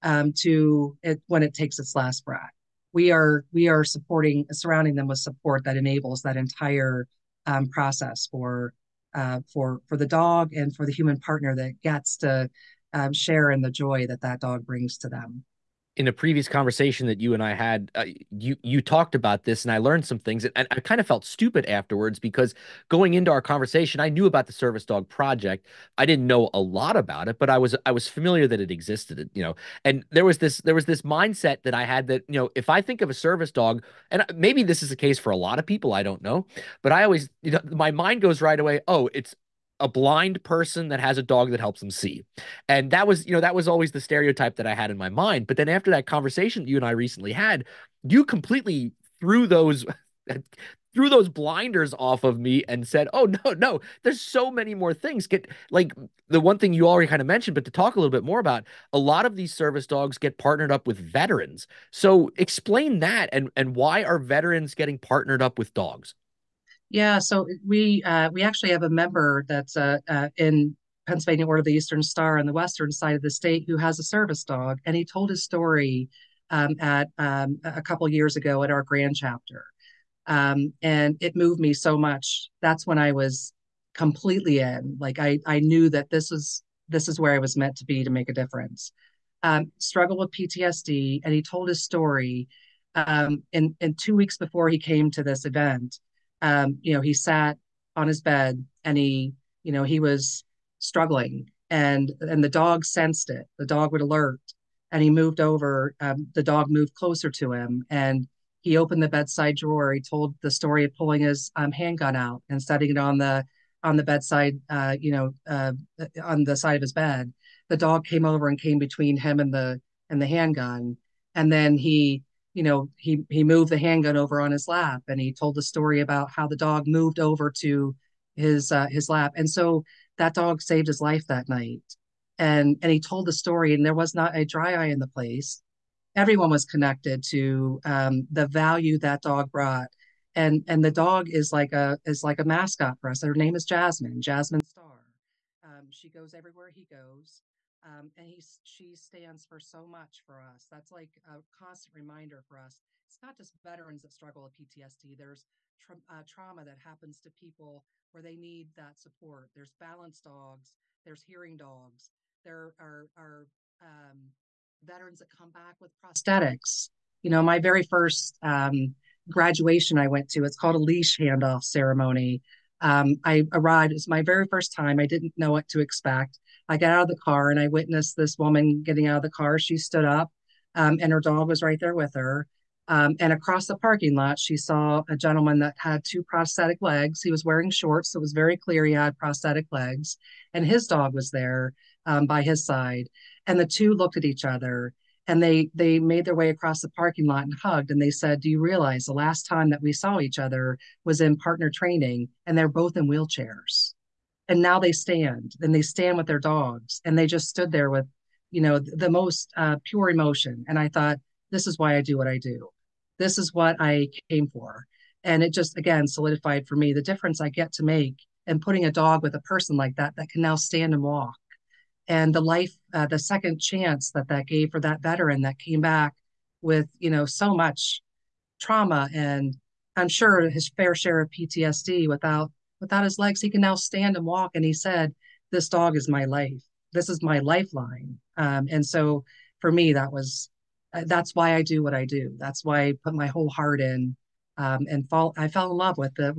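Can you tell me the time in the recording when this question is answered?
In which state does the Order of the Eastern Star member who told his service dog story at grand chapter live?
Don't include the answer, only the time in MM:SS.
01:11.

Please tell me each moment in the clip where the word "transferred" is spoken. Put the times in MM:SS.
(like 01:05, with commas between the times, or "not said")
not said.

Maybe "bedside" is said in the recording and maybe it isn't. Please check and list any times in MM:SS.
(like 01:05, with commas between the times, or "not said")
01:49, 01:54.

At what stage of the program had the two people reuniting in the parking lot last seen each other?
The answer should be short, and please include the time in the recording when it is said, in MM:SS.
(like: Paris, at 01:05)
Partner training, at 03:21.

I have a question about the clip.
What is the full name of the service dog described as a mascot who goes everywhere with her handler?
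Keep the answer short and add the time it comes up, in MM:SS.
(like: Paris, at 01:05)
Jasmine Star, at 02:24.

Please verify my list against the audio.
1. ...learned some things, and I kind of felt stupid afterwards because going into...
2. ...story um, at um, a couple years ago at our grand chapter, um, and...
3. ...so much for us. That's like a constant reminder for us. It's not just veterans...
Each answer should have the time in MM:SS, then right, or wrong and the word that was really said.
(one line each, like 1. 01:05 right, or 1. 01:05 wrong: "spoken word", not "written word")
1. 00:19 right
2. 01:15 right
3. 02:29 right.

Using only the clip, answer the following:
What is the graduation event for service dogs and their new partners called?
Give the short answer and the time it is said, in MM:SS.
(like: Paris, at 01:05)
Leash handoff ceremony, at 02:50.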